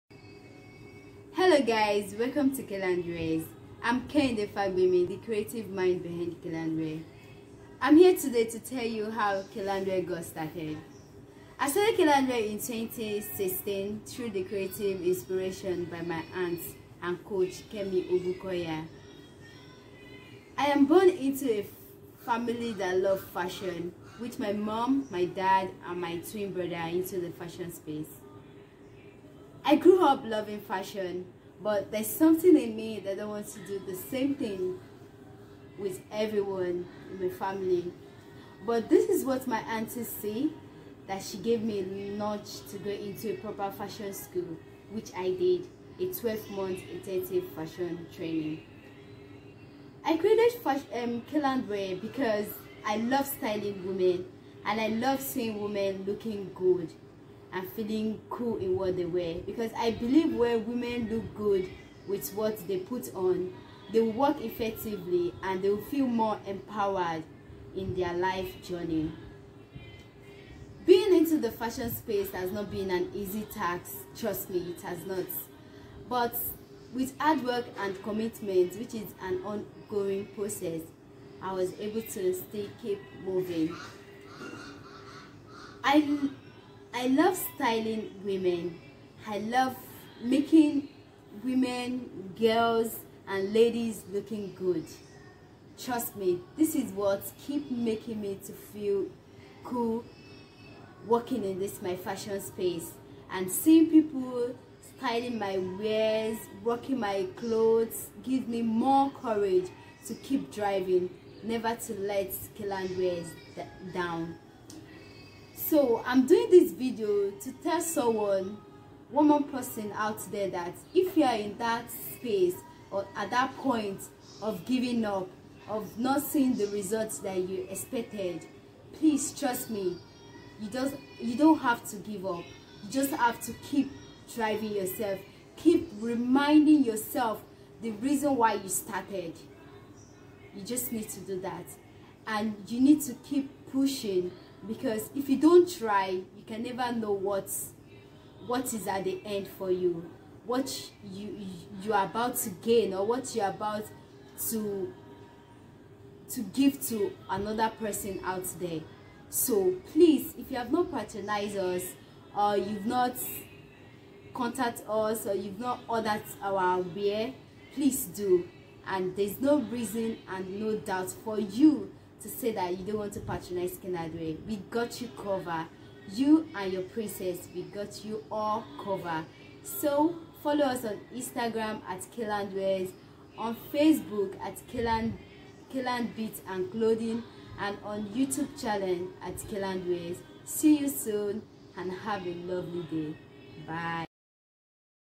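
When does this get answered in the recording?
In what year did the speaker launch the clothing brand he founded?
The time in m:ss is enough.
0:12.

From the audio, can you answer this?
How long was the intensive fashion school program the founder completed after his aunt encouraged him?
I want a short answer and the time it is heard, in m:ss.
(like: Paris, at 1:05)
12 months, at 0:46.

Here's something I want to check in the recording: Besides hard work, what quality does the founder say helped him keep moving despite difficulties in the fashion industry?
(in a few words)
Commitment.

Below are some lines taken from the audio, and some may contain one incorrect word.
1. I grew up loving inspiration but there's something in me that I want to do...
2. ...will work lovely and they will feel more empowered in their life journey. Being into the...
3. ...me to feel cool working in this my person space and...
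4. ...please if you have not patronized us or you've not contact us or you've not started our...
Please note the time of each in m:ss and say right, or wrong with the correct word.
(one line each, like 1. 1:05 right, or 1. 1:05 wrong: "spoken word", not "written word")
1. 0:29 wrong: "fashion", not "inspiration"
2. 1:04 wrong: "effectively", not "lovely"
3. 1:38 wrong: "fashion", not "person"
4. 2:39 wrong: "ordered", not "started".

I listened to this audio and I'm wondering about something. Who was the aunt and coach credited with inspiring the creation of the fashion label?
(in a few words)
Kemi Obukoya.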